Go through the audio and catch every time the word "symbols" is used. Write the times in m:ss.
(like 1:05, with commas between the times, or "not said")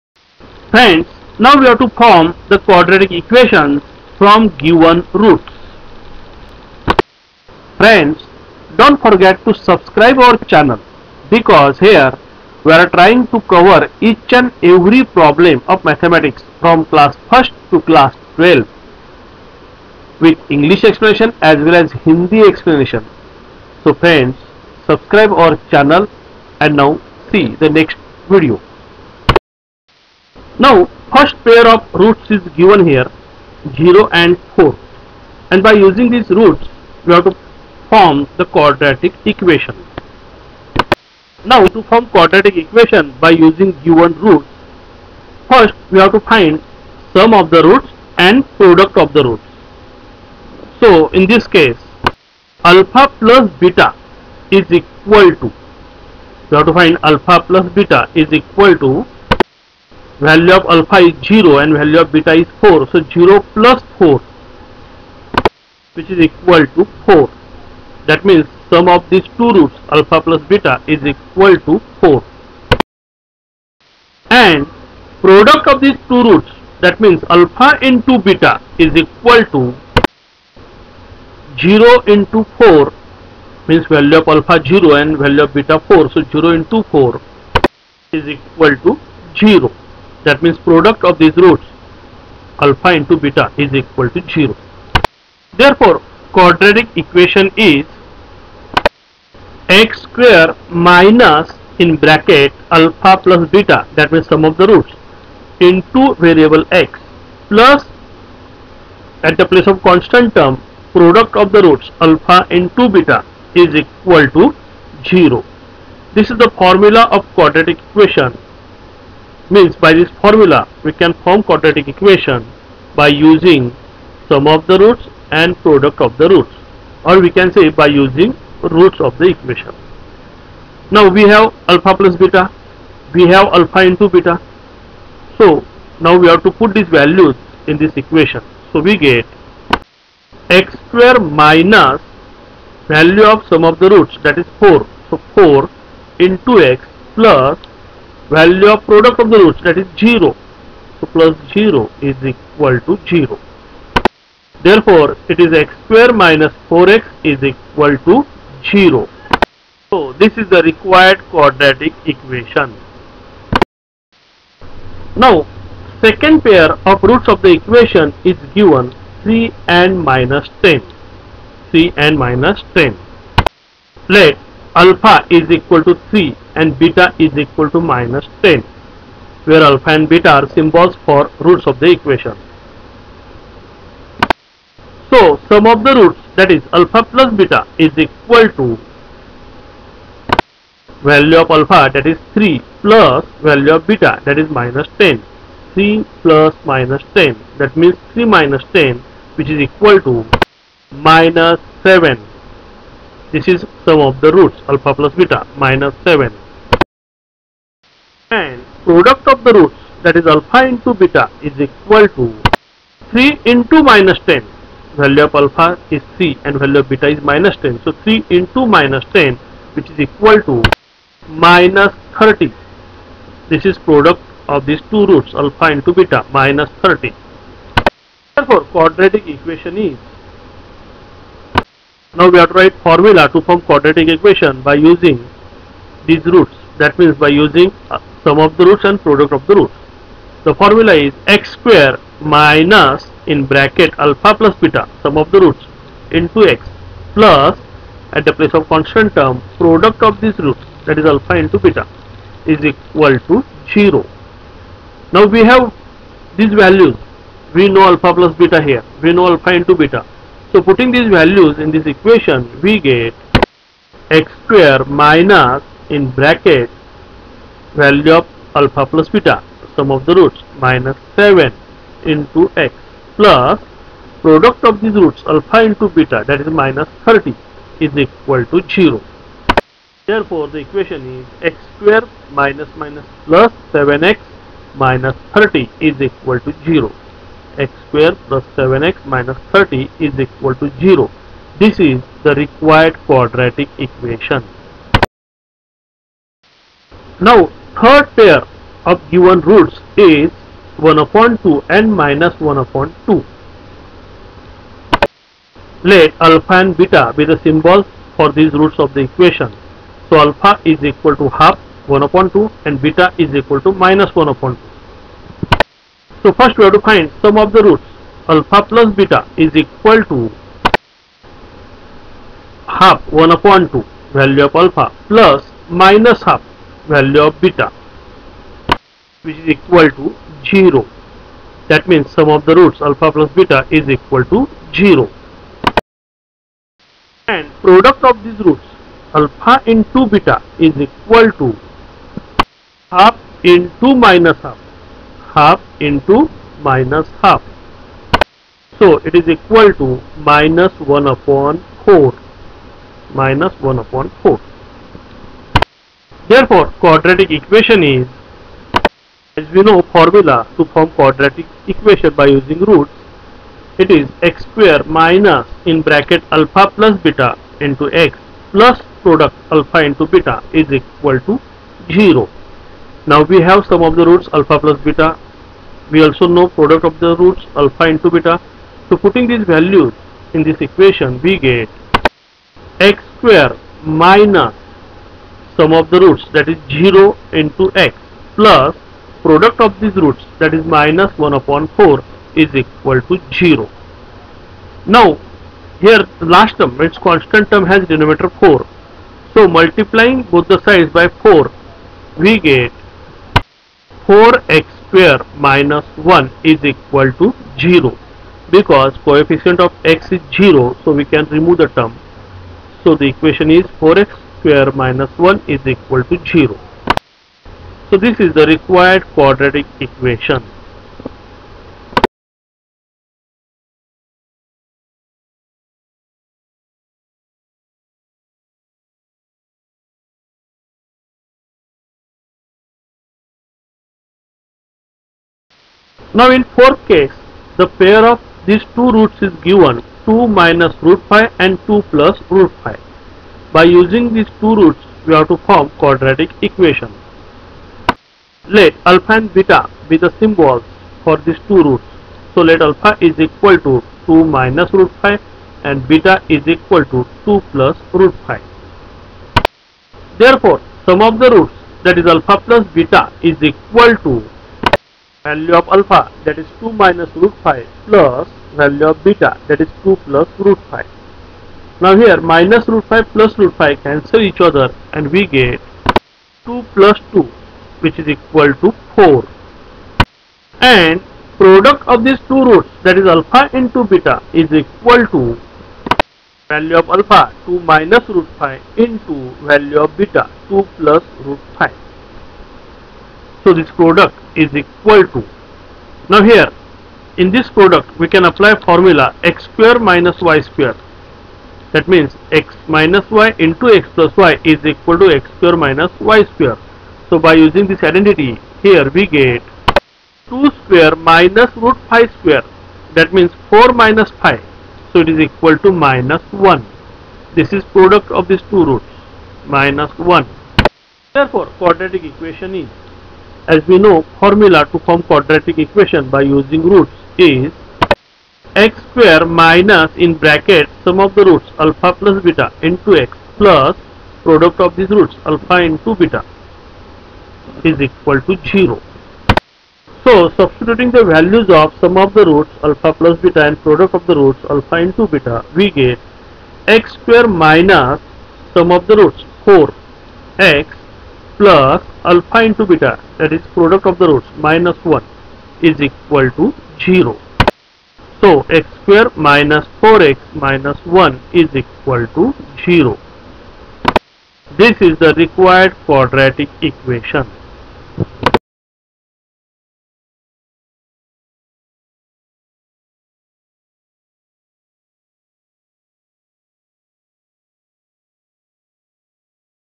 3:00, 5:07, 7:30.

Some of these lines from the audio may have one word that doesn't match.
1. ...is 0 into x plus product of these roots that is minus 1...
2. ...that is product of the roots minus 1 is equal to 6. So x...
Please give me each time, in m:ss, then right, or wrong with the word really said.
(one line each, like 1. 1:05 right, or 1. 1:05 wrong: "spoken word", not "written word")
1. 6:26 right
2. 9:13 wrong: "0", not "6".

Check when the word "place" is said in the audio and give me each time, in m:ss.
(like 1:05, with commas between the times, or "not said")
1:49, 4:08.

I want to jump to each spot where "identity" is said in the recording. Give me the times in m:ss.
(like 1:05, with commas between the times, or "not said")
8:27.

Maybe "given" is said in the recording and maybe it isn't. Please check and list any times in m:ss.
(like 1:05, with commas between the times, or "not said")
0:04, 0:32, 0:43, 2:48, 4:59, 7:19.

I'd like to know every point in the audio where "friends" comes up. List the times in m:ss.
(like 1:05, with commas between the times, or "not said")
0:00, 0:07, 0:23.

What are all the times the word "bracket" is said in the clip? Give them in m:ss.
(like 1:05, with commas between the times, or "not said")
1:42, 4:03, 4:26, 6:05, 8:50.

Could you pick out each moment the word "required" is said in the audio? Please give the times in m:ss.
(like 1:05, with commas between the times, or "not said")
2:40, 4:52, 6:58, 9:25.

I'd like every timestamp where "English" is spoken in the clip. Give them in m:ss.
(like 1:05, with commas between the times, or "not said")
0:20.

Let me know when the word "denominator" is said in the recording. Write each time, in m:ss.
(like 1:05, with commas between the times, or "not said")
6:37.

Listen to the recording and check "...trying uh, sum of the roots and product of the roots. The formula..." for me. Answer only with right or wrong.
wrong.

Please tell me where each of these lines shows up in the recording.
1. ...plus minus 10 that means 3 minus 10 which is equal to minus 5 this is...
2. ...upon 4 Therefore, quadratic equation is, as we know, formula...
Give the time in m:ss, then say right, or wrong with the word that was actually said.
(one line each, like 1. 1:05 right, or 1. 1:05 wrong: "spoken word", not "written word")
1. 3:16 wrong: "7", not "5"
2. 5:53 right.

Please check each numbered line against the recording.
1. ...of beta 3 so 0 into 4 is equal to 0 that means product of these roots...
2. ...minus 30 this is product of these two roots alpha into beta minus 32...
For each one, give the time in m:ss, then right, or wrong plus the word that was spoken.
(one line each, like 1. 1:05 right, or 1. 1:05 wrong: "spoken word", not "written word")
1. 1:25 wrong: "4", not "3"
2. 3:41 wrong: "30", not "32".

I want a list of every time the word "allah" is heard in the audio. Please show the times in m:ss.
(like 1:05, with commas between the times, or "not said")
not said.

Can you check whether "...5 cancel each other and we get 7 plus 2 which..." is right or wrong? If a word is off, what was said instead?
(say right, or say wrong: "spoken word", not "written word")
wrong: "2", not "7".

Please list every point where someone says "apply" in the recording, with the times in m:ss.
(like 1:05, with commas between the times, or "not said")
8:18.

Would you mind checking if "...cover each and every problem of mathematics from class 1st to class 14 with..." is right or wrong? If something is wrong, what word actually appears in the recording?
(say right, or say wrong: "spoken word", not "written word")
wrong: "12", not "14".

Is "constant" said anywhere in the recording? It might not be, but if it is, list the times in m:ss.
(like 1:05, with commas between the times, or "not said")
1:49, 4:08, 6:36.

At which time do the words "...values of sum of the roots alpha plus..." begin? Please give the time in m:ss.
9:01.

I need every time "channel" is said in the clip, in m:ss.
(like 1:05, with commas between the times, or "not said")
0:10, 0:25.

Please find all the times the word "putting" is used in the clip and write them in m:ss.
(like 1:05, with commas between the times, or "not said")
4:20, 6:18.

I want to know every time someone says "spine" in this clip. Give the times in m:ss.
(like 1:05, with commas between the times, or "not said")
not said.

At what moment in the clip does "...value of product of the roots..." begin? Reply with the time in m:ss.
2:28.